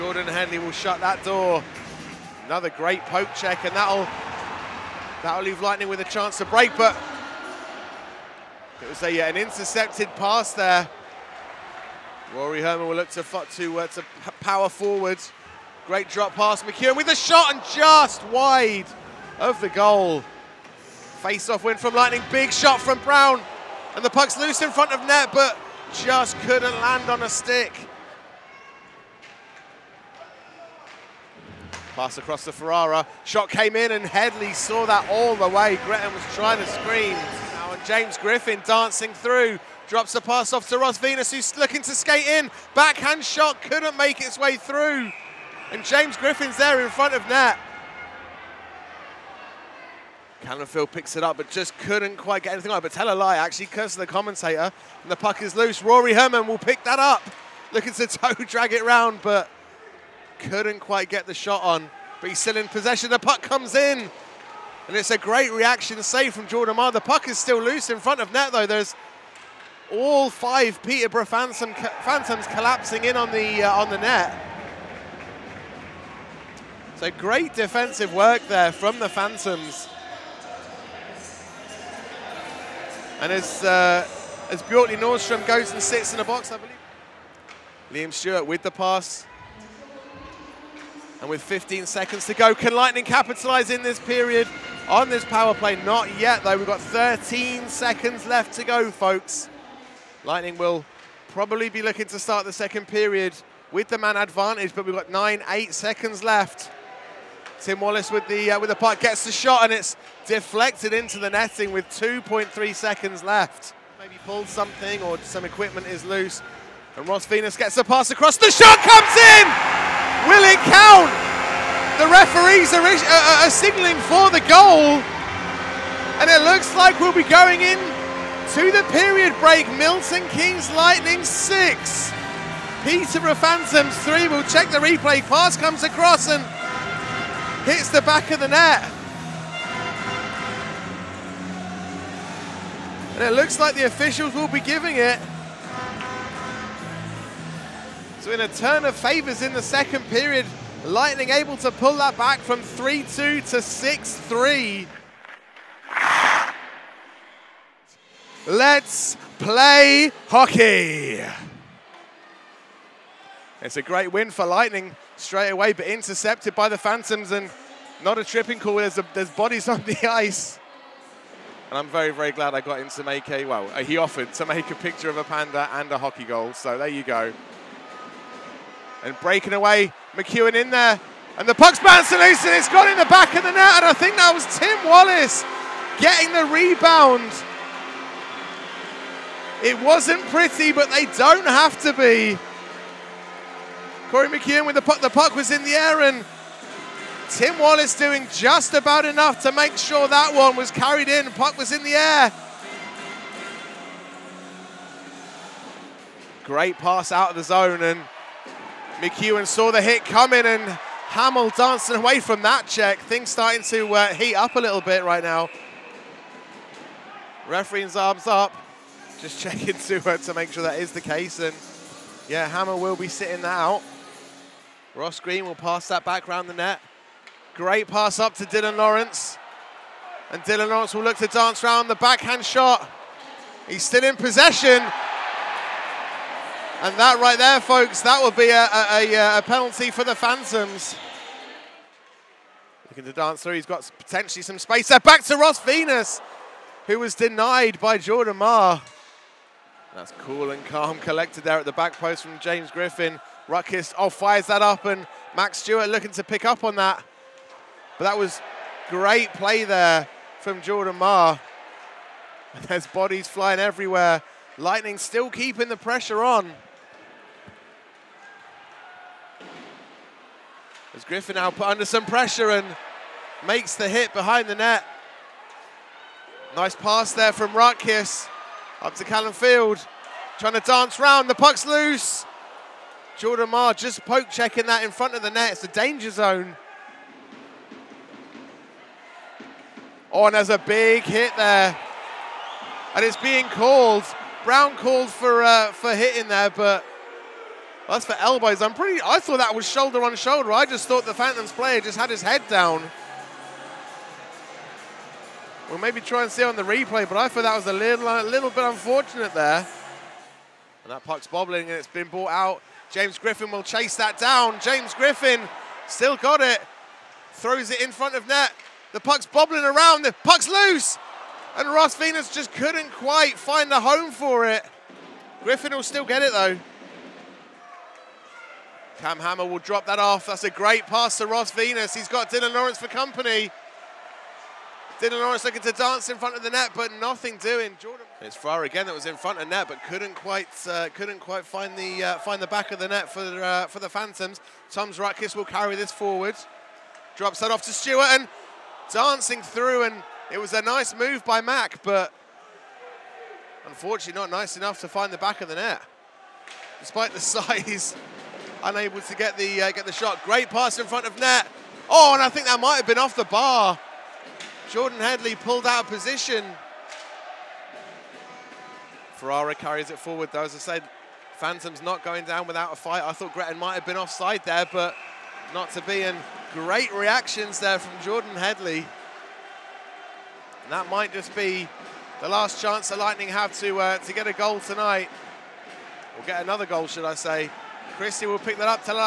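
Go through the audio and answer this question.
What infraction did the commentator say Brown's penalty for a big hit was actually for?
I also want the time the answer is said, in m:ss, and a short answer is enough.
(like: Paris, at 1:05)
Elbows, at 4:58.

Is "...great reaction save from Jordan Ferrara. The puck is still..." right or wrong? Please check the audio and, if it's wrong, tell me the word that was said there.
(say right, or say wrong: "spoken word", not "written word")
wrong: "Marr", not "Ferrara".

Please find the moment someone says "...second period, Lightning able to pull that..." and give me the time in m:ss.
2:29.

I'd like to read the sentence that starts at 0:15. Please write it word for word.
Great drop pass, McEwen with a shot and just wide of the goal.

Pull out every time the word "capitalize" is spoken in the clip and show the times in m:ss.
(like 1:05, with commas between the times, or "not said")
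1:33.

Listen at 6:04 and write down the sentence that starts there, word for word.
Jordan Headley pulled out of position.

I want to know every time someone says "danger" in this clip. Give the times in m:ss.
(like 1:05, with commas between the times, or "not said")
4:45.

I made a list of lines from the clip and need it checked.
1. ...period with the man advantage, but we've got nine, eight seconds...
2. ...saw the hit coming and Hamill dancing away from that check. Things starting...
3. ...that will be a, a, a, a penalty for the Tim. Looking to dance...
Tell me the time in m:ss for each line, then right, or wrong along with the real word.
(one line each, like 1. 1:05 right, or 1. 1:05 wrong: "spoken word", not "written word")
1. 1:42 right
2. 3:29 right
3. 3:58 wrong: "Phantoms", not "Tim".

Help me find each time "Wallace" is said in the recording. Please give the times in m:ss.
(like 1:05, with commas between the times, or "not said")
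1:47, 3:04, 3:17.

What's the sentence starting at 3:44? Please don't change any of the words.
Ross Green will pass that back round the net.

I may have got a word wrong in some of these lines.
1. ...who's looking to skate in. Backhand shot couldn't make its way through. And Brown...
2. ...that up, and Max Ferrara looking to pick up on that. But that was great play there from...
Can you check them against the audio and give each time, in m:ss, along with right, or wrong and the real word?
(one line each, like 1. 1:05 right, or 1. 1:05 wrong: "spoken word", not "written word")
1. 0:41 wrong: "James", not "Brown"
2. 4:14 wrong: "Stewart", not "Ferrara".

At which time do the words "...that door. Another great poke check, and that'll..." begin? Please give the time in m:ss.
0:01.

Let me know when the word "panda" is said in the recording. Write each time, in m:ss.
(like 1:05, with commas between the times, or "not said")
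2:55.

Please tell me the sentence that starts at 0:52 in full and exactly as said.
But tell a lie, actually, curse the commentator.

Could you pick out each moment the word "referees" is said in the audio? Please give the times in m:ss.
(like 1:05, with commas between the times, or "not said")
2:02, 3:37.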